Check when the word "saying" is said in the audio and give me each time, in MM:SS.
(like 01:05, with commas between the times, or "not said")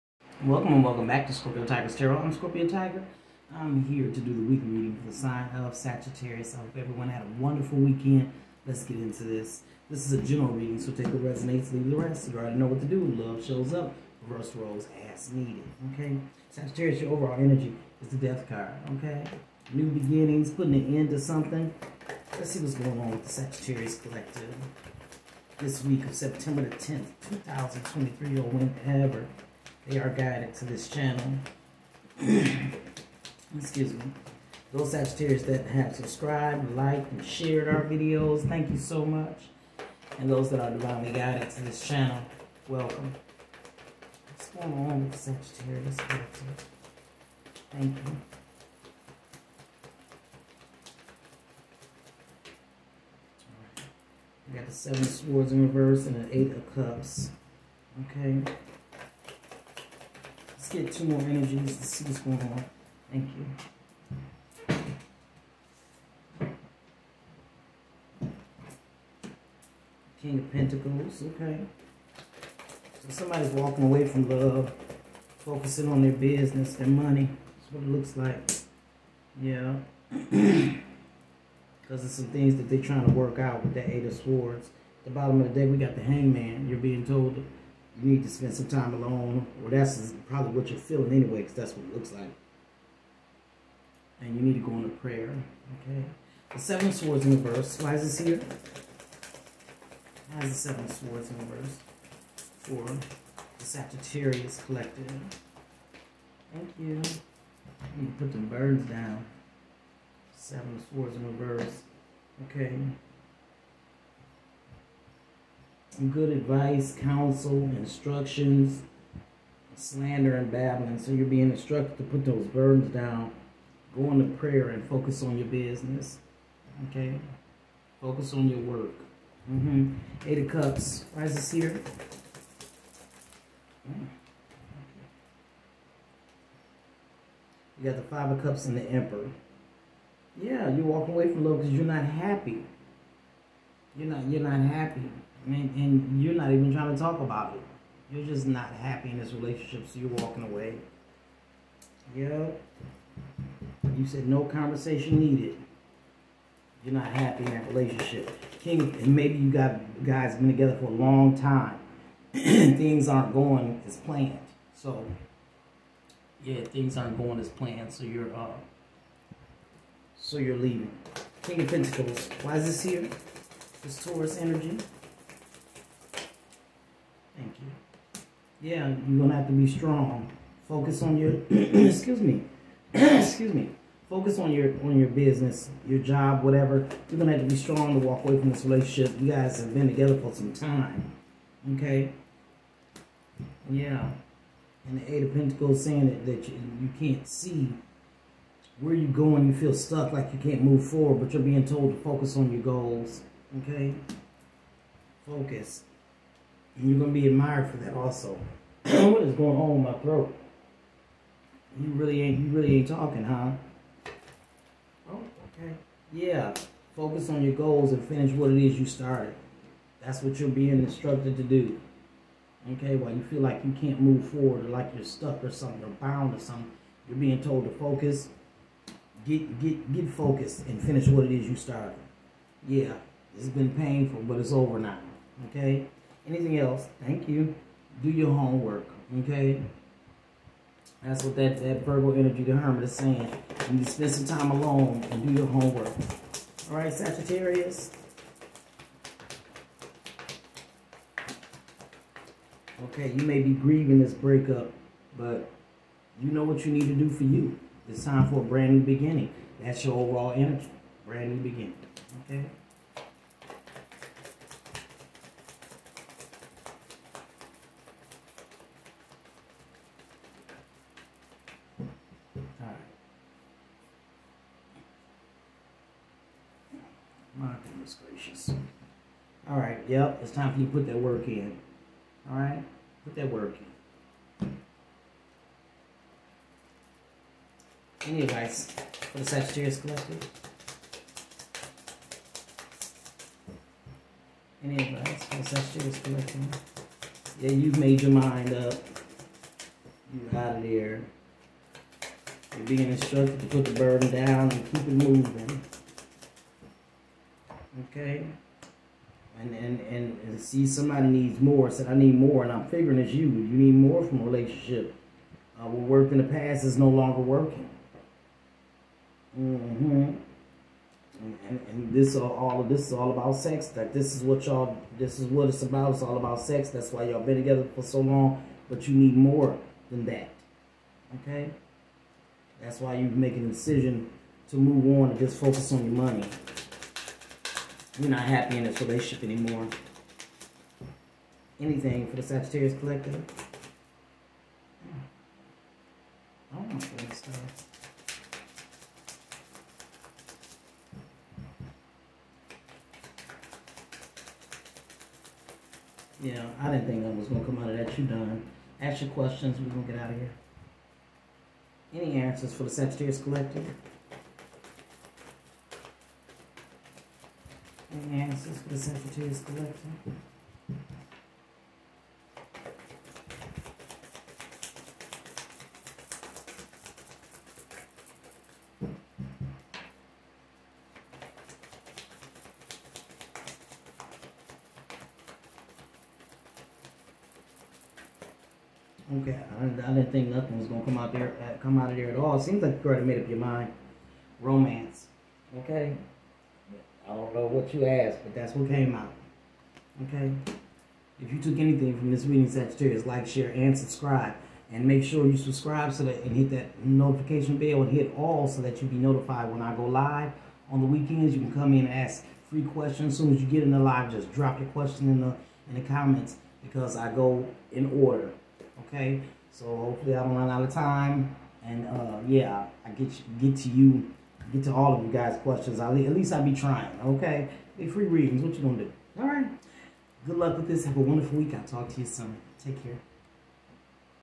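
03:15, 04:02.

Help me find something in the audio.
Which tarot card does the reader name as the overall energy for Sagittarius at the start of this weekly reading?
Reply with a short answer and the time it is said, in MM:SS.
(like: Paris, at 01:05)
The Death card, at 00:18.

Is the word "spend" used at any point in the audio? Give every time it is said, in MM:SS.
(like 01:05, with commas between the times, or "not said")
01:28, 04:03.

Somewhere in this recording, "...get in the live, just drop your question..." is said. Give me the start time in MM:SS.
06:53.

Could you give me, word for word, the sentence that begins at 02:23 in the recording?
You're not, you're not happy and, and you're not even trying to talk about it.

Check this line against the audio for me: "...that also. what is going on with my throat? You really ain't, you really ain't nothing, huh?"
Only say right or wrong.
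wrong.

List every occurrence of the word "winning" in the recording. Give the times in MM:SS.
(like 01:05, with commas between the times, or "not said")
not said.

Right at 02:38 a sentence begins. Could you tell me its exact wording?
King, and maybe you got guys been together for a long time.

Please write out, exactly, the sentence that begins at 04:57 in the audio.
Yeah, you've made your mind up.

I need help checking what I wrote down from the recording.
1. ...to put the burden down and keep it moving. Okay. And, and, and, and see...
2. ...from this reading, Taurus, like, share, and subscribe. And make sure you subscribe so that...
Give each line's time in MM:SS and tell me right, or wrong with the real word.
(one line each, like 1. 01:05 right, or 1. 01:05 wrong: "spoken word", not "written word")
1. 05:03 right
2. 06:41 wrong: "Sagittarius", not "Taurus".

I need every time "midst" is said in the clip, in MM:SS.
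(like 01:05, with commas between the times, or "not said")
not said.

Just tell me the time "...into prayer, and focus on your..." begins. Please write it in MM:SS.
02:04.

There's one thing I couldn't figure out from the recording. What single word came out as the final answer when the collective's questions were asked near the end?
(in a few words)
Romance.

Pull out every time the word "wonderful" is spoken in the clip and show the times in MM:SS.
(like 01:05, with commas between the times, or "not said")
00:07, 07:10.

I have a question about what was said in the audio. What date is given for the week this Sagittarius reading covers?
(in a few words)
September 10th, 2023.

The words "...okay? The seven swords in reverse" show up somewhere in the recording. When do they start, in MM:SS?
01:35.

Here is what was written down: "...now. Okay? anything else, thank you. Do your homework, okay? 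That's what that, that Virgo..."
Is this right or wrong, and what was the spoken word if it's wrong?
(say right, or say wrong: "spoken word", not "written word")
right.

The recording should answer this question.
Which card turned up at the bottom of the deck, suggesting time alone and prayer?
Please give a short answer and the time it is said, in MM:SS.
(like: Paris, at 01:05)
The Hangman, at 01:25.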